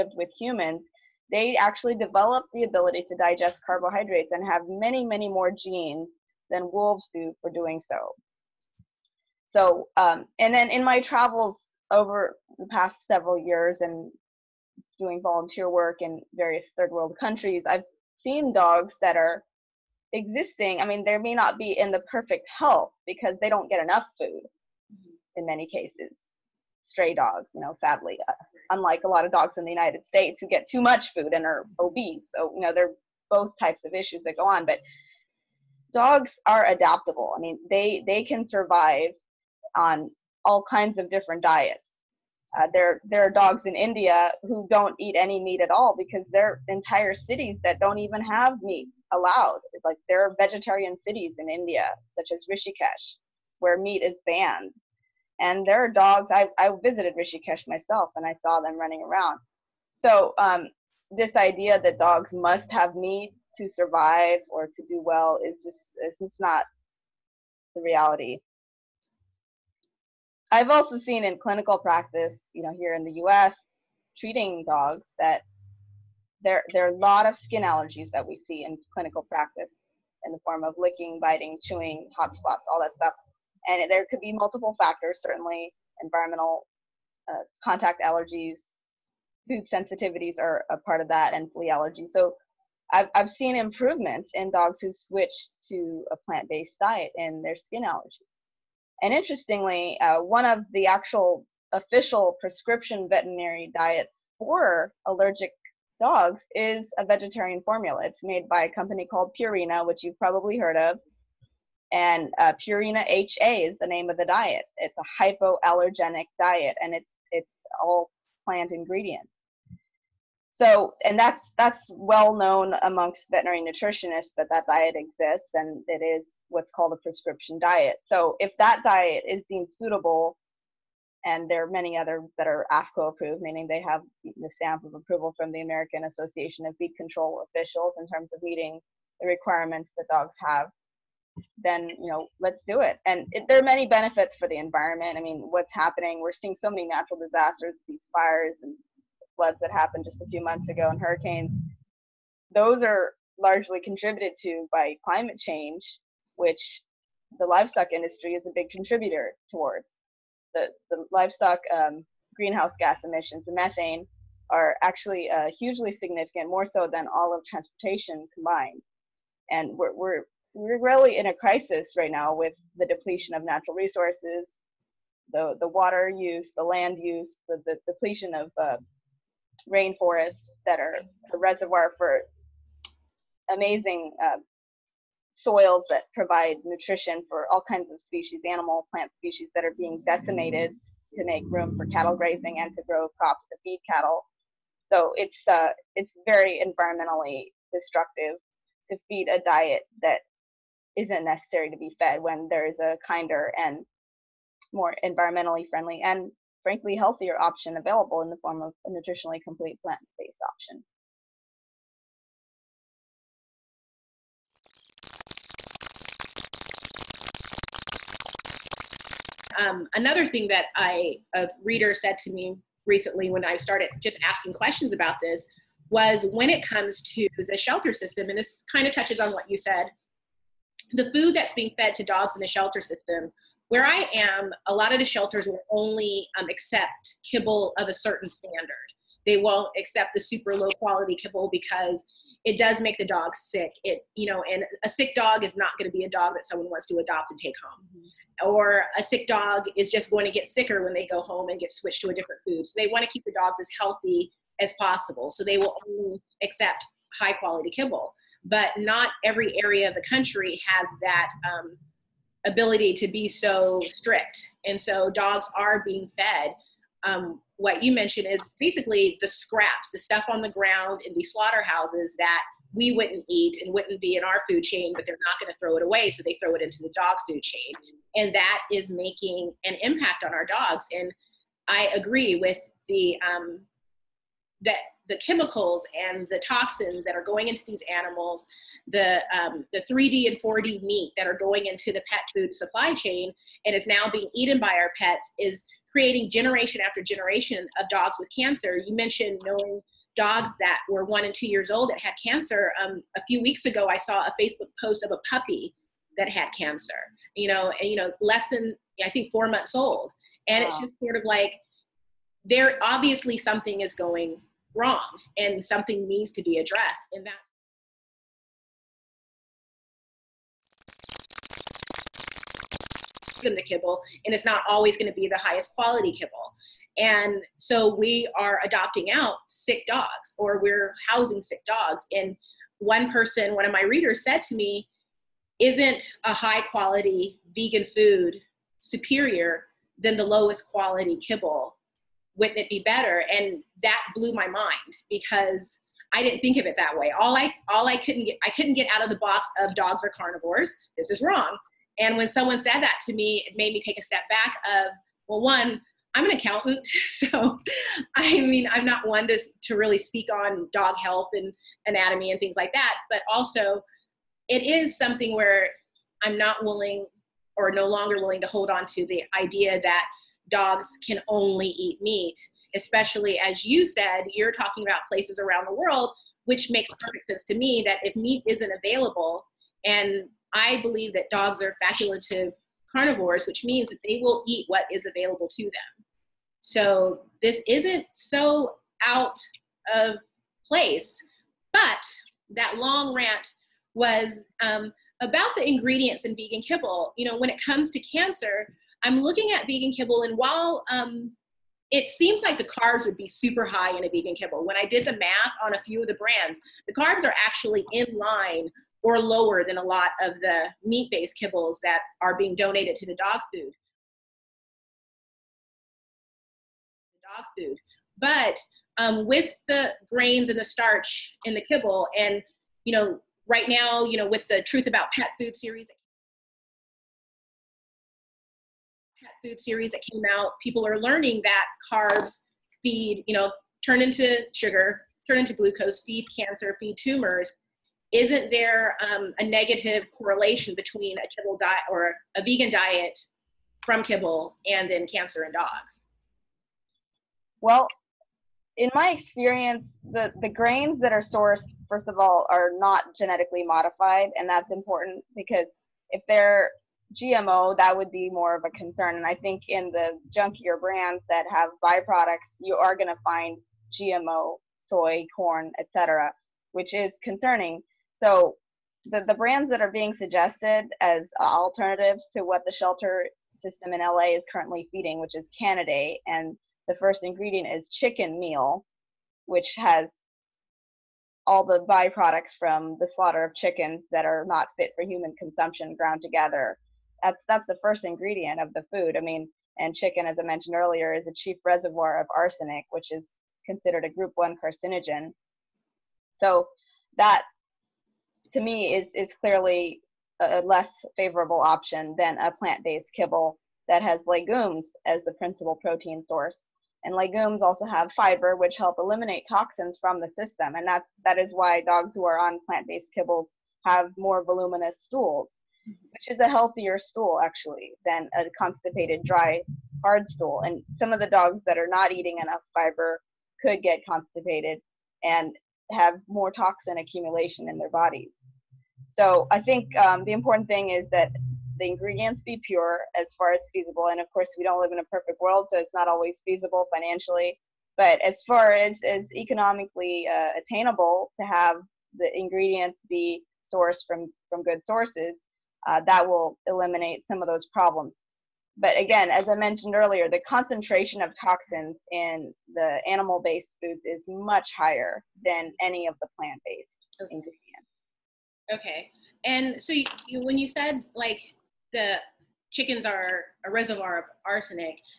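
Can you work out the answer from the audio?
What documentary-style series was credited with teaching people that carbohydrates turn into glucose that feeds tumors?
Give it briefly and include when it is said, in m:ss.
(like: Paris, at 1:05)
The Truth About Pet Food, at 7:04.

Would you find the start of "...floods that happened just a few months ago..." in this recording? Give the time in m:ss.
2:29.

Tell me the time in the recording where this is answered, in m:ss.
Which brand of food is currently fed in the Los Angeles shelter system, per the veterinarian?
7:55.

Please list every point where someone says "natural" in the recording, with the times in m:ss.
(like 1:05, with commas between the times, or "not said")
2:26, 2:53.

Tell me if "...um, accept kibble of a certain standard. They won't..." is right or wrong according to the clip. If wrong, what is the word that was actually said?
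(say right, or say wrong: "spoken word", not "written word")
right.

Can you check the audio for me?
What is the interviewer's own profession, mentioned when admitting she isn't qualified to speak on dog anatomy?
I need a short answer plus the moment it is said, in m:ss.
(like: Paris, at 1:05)
Accountant, at 5:56.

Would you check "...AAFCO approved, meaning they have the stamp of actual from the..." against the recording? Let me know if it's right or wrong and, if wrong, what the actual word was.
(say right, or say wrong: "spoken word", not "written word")
wrong: "approval", not "actual".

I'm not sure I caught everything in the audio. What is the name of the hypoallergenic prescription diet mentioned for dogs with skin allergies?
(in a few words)
Purina HA.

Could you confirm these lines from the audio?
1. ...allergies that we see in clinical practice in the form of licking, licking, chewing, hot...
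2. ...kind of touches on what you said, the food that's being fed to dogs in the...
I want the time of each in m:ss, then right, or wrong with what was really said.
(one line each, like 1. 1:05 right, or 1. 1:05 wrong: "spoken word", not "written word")
1. 1:17 wrong: "biting", not "licking"
2. 3:48 right.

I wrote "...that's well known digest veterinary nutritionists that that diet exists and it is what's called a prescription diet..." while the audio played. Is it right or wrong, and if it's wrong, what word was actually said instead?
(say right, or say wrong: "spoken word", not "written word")
wrong: "amongst", not "digest".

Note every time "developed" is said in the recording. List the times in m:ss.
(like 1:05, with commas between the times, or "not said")
0:01.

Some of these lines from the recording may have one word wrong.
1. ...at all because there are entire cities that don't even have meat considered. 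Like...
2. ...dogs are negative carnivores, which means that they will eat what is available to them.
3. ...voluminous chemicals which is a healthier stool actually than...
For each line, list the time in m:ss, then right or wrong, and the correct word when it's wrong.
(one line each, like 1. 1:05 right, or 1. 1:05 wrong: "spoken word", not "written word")
1. 0:45 wrong: "allowed", not "considered"
2. 6:21 wrong: "facultative", not "negative"
3. 8:34 wrong: "stools", not "chemicals".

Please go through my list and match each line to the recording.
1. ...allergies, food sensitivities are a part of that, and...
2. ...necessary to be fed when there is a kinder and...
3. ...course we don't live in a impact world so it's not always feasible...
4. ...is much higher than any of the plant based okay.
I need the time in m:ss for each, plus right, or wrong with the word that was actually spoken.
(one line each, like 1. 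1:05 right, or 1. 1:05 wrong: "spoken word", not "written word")
1. 1:28 right
2. 3:21 right
3. 8:54 wrong: "perfect", not "impact"
4. 9:14 right.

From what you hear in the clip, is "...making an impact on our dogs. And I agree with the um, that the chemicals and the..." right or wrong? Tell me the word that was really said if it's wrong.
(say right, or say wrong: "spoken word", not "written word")
right.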